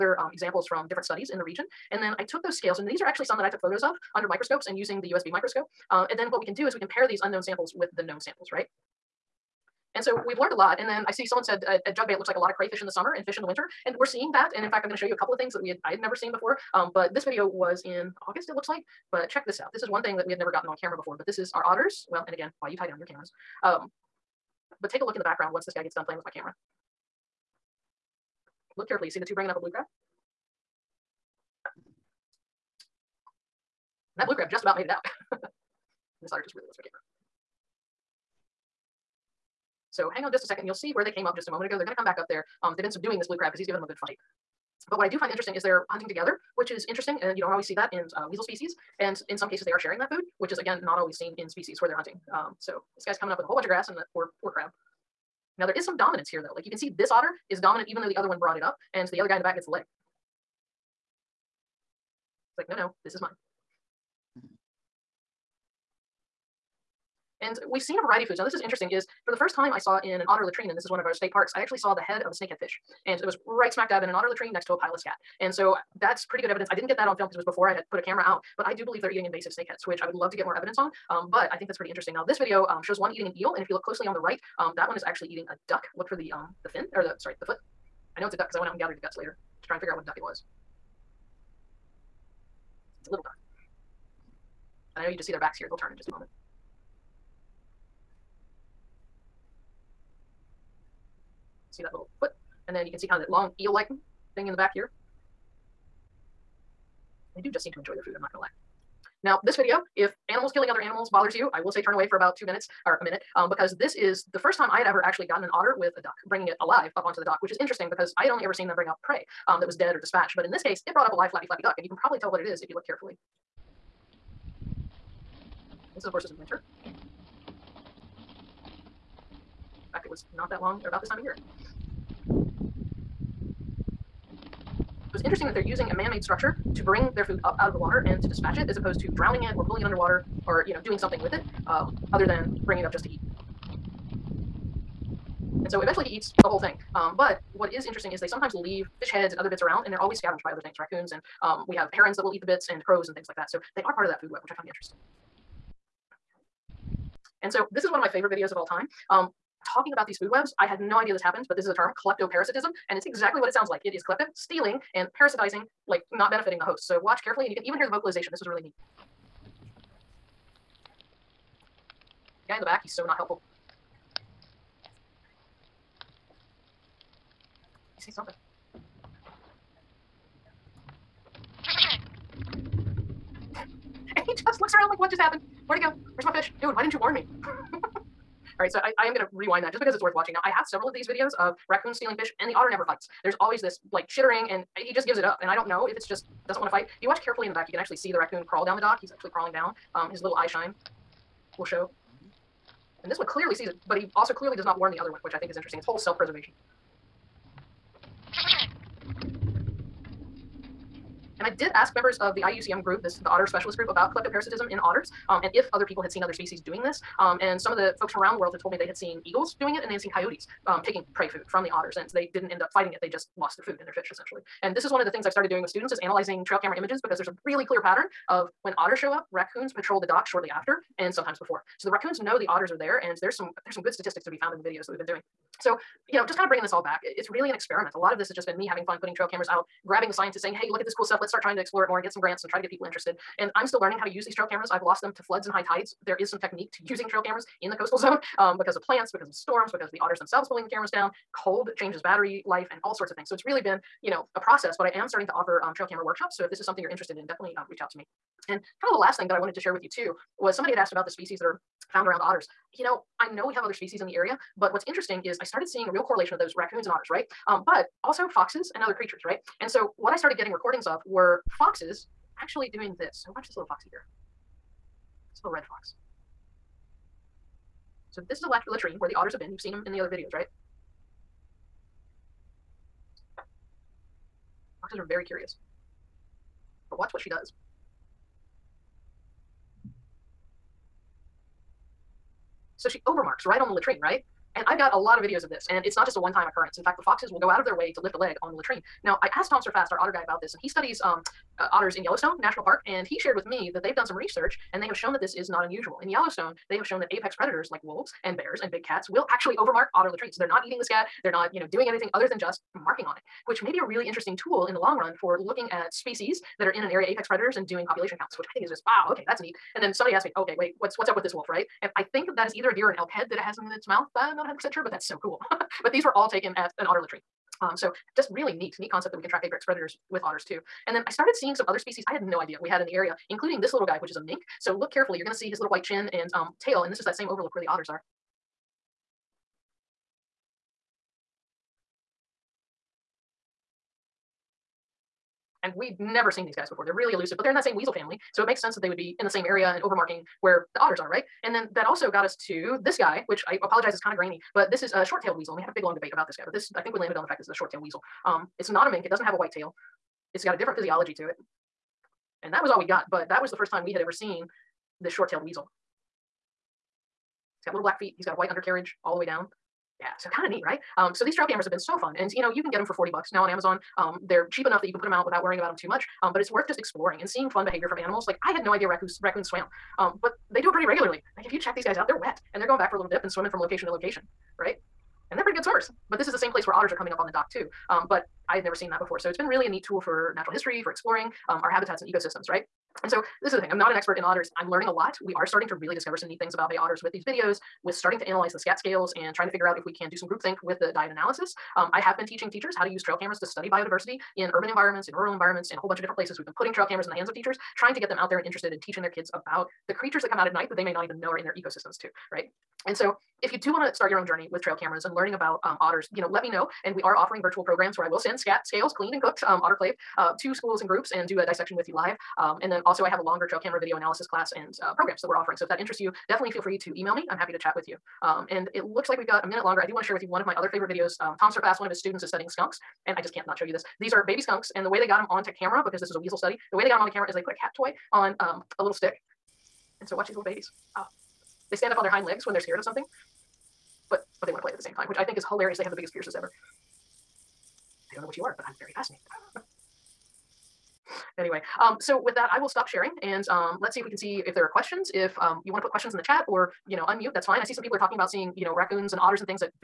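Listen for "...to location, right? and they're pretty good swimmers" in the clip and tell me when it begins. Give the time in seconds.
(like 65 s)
383 s.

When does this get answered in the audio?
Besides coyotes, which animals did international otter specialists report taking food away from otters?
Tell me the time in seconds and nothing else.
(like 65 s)
219 s.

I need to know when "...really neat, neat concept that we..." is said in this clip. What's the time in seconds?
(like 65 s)
328 s.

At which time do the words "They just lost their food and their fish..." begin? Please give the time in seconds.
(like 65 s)
223 s.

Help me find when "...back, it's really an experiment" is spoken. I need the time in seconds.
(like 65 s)
236 s.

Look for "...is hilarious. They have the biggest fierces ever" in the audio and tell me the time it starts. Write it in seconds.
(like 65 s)
445 s.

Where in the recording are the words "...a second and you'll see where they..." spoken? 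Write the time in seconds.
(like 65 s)
40 s.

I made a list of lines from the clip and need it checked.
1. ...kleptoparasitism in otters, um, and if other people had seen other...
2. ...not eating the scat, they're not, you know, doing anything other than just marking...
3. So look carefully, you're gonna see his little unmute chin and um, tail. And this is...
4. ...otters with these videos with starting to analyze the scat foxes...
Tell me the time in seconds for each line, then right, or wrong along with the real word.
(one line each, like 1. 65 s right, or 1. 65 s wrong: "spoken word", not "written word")
1. 214 s right
2. 310 s right
3. 334 s wrong: "white", not "unmute"
4. 396 s wrong: "scales", not "foxes".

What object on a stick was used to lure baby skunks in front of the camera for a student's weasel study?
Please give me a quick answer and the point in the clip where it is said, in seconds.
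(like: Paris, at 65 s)
cat toy, at 437 s.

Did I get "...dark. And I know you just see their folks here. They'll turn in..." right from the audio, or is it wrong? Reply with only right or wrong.
wrong.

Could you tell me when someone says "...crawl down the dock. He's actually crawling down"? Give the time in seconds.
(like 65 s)
198 s.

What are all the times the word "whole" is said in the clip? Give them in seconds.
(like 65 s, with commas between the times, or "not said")
53 s, 146 s, 205 s, 405 s.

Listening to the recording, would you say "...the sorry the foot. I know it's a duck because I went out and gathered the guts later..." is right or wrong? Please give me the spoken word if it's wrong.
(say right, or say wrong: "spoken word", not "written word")
right.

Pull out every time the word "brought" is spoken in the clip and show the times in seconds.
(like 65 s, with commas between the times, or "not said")
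58 s, 120 s.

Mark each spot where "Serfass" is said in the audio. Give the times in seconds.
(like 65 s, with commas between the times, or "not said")
299 s, 431 s.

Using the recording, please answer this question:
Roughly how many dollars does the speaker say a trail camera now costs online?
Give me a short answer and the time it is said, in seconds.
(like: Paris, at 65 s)
40, at 372 s.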